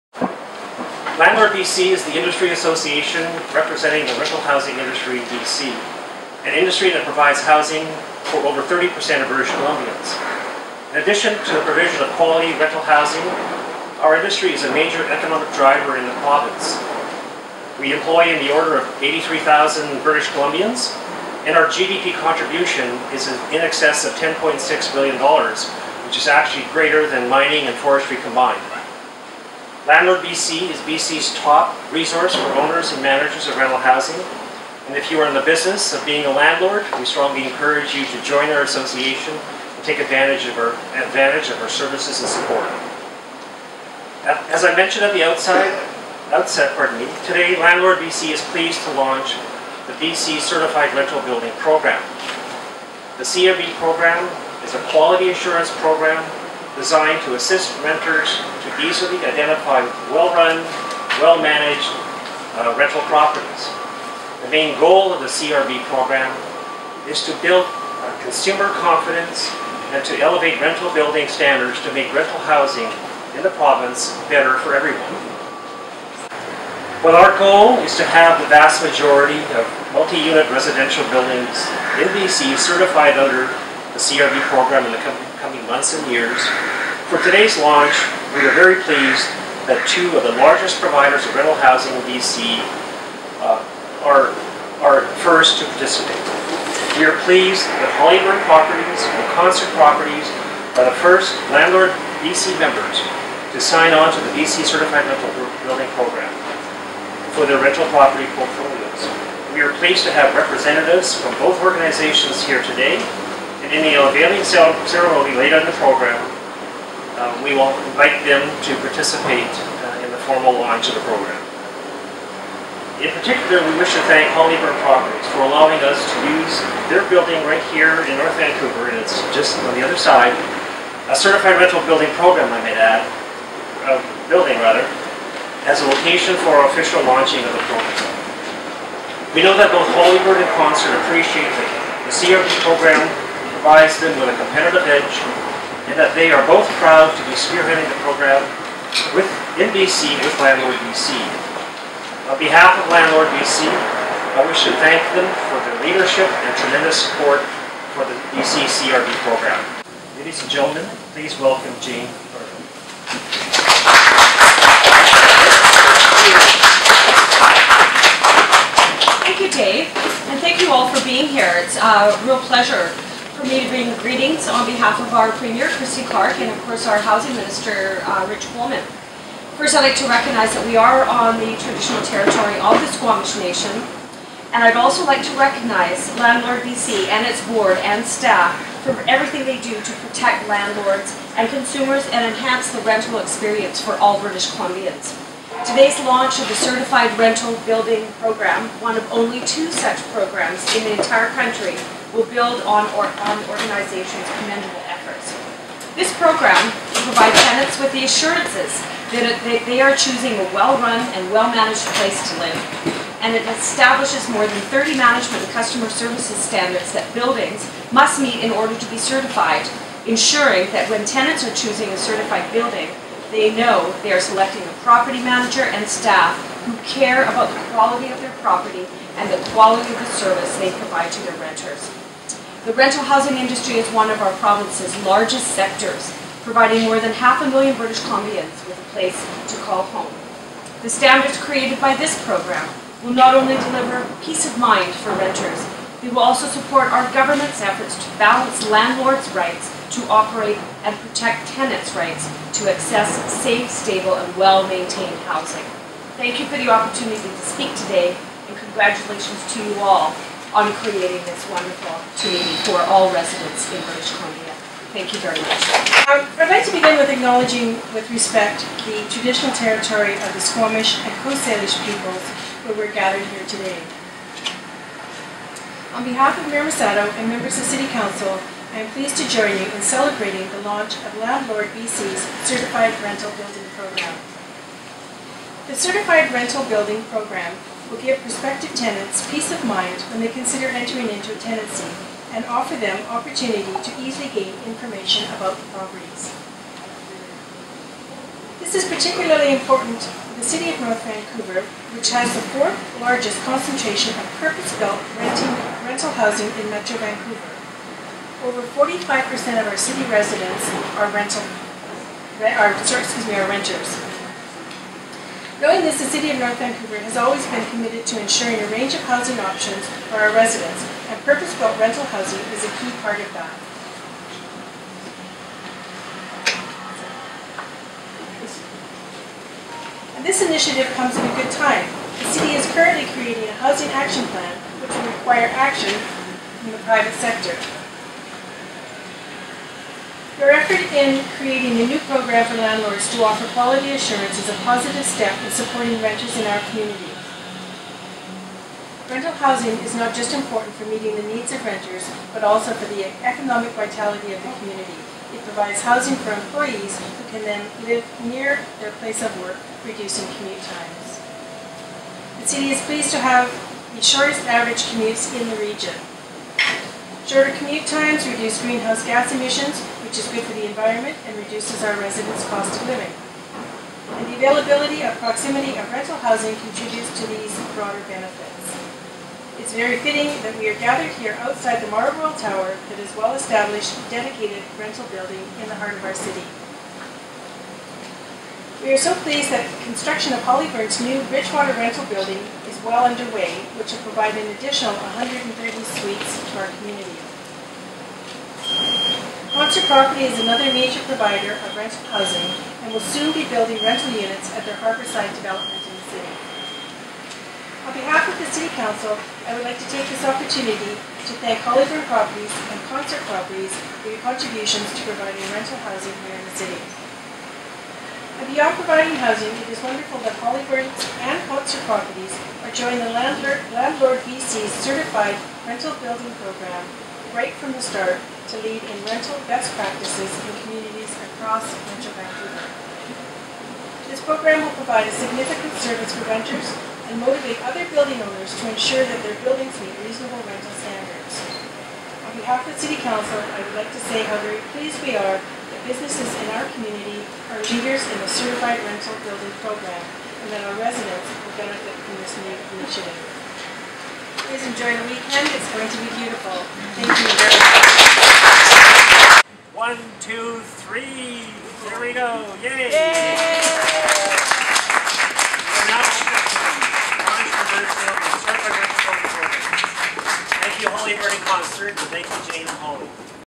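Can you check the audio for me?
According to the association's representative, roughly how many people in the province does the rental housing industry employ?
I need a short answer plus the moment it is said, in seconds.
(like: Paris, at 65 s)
83,000, at 19 s.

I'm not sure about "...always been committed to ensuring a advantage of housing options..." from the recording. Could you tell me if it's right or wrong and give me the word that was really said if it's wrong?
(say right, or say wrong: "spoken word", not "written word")
wrong: "range", not "advantage".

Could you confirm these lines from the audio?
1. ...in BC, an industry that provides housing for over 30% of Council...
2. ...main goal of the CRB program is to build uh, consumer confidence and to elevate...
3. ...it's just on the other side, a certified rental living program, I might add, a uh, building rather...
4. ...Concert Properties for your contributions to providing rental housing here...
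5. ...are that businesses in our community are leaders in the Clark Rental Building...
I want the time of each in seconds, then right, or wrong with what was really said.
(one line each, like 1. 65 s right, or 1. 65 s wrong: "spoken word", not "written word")
1. 5 s wrong: "British", not "Council"
2. 64 s right
3. 128 s wrong: "building", not "living"
4. 412 s right
5. 445 s wrong: "Certified", not "Clark".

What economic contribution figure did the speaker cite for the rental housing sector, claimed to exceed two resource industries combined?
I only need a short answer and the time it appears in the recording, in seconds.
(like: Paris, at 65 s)
$10.6 billion, at 24 s.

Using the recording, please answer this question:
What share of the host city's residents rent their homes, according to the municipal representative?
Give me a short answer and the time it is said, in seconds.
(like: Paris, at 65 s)
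Over 45%, at 308 s.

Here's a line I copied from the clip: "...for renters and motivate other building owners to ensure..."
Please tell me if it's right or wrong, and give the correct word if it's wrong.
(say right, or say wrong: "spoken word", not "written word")
right.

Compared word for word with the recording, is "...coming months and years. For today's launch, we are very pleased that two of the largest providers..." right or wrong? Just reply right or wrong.
right.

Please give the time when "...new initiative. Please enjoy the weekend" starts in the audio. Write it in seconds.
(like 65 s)
452 s.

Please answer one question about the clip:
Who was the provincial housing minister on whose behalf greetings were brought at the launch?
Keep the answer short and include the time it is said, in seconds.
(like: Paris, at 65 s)
Rich Coleman, at 178 s.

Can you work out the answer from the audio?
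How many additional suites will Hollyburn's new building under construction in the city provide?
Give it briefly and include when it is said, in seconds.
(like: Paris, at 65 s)
130, at 395 s.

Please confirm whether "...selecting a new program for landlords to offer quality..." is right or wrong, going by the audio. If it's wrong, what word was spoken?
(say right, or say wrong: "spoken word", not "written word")
wrong: "creating", not "selecting".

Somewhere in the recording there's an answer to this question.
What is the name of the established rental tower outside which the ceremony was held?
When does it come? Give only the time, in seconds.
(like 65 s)
381 s.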